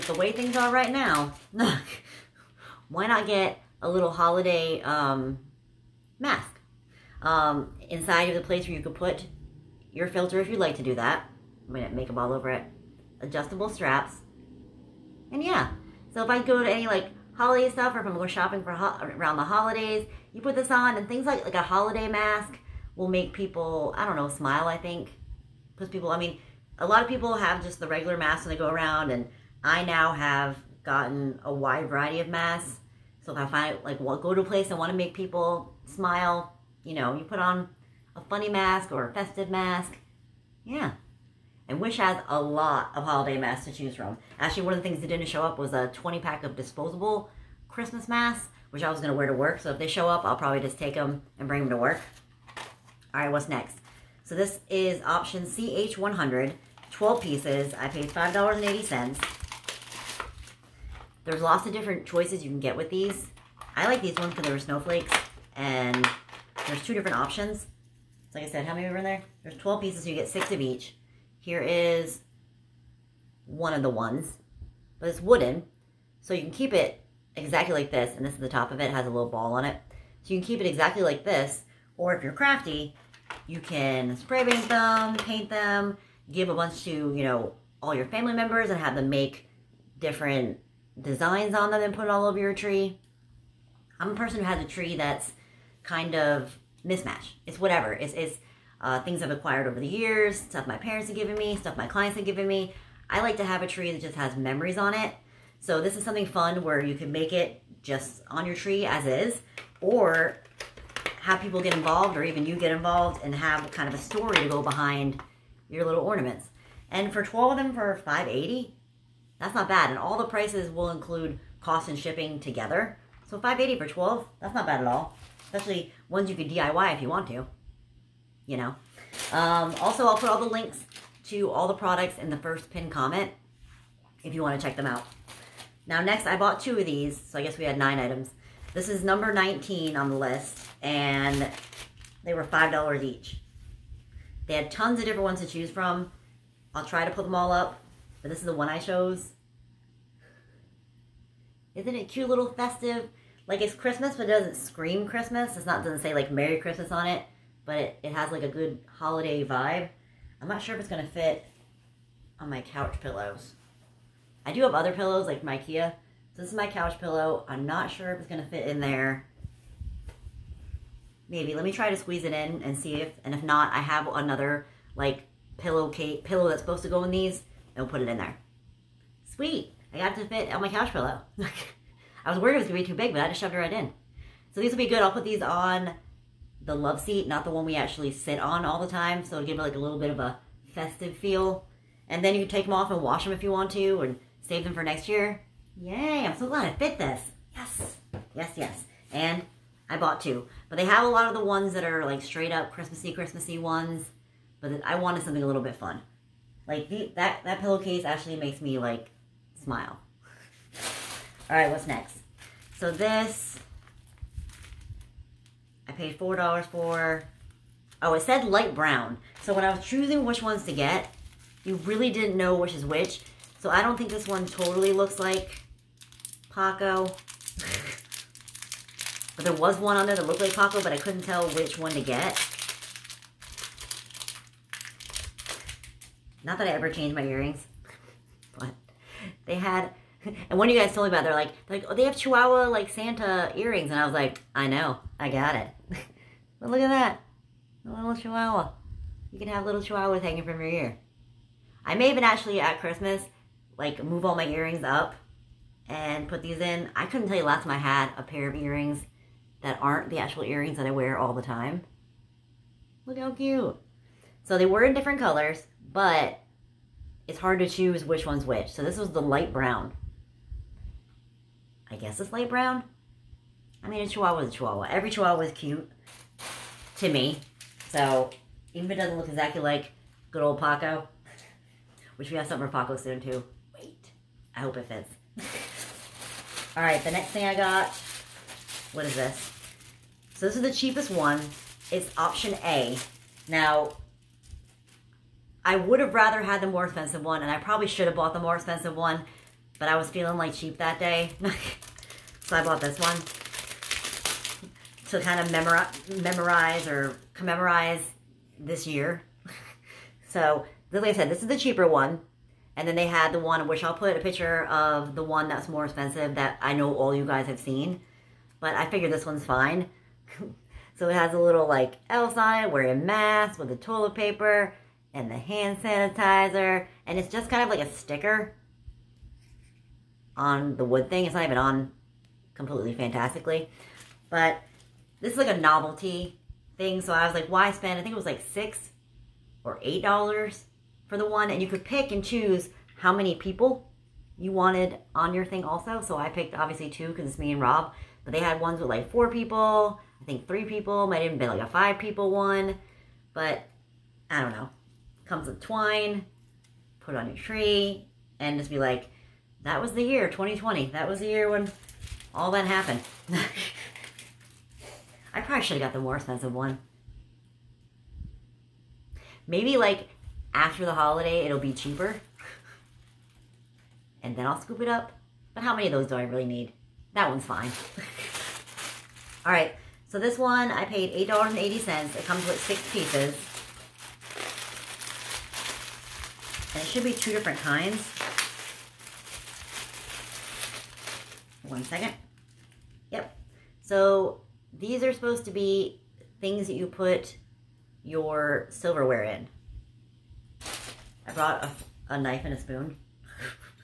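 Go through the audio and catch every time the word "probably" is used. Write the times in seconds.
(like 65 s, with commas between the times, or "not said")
50 s, 297 s, 365 s.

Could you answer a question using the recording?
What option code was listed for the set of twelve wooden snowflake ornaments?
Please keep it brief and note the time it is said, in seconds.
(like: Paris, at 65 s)
CH100, at 55 s.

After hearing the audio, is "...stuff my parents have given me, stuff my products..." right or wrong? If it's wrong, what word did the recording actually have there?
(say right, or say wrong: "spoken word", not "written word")
wrong: "clients", not "products".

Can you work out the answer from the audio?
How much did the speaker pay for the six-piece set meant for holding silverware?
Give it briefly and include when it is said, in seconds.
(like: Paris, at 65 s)
$8.80, at 381 s.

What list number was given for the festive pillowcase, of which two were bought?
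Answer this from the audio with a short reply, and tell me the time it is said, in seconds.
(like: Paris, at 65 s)
19, at 139 s.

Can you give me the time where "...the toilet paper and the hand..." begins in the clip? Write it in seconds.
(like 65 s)
323 s.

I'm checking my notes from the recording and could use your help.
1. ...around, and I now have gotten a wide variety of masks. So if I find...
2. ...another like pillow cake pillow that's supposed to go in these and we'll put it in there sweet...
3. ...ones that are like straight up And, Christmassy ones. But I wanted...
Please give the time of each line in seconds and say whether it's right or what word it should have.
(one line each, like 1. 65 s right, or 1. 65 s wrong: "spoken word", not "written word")
1. 28 s right
2. 174 s right
3. 201 s wrong: "Christmassy", not "And".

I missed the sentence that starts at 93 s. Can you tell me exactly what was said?
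I'm a person who has a tree that's kind of mismatch.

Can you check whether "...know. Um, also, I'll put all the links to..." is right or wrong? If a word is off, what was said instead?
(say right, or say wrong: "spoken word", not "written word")
right.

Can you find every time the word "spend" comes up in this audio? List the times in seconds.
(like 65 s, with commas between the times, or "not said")
337 s.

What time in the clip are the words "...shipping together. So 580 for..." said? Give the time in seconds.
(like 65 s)
121 s.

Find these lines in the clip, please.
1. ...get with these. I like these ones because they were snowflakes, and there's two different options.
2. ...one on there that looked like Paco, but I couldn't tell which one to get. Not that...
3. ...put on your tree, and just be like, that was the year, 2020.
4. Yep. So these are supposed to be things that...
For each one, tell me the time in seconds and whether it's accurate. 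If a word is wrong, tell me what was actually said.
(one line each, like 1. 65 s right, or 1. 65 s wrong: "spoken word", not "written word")
1. 62 s right
2. 229 s right
3. 356 s right
4. 393 s right.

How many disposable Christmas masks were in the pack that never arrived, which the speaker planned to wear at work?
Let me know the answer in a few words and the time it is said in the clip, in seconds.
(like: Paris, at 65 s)
20, at 45 s.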